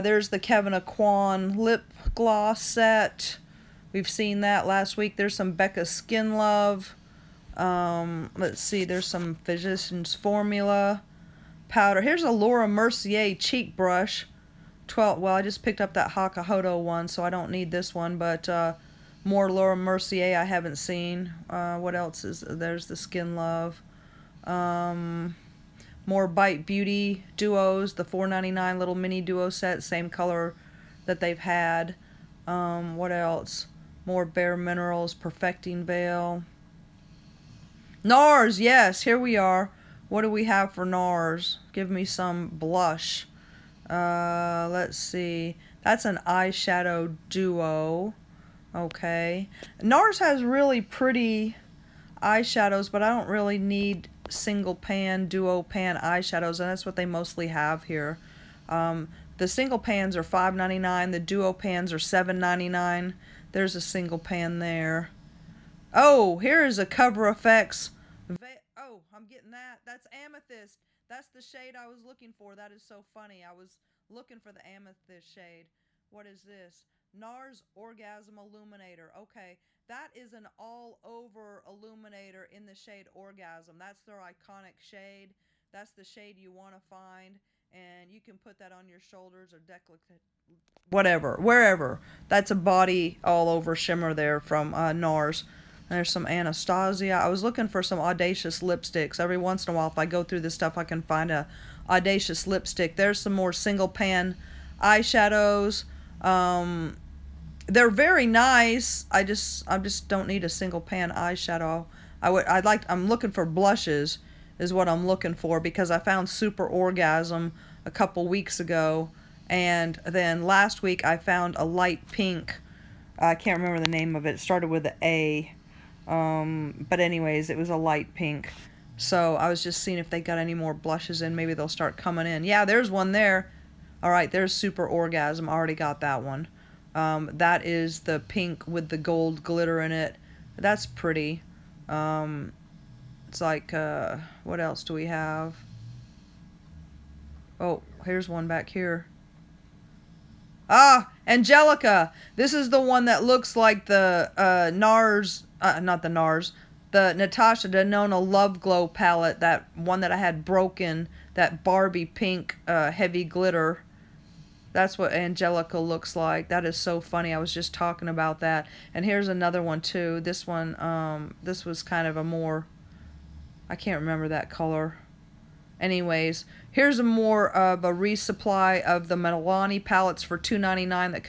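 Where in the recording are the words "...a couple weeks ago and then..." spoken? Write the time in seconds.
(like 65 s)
117 s.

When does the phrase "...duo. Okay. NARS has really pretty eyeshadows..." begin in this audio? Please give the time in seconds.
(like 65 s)
47 s.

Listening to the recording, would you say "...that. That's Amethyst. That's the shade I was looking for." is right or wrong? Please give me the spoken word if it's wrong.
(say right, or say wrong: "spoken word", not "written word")
right.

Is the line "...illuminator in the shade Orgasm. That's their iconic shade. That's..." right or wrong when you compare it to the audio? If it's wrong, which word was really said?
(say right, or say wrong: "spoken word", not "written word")
right.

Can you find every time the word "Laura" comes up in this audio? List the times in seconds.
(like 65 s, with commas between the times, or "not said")
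12 s, 19 s.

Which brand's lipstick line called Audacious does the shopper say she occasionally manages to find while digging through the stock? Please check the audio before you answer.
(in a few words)
Anastasia.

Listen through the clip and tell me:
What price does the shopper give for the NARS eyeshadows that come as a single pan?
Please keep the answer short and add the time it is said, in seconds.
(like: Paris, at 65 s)
$5.99, at 60 s.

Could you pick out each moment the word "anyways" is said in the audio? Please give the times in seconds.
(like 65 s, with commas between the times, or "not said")
127 s, 175 s.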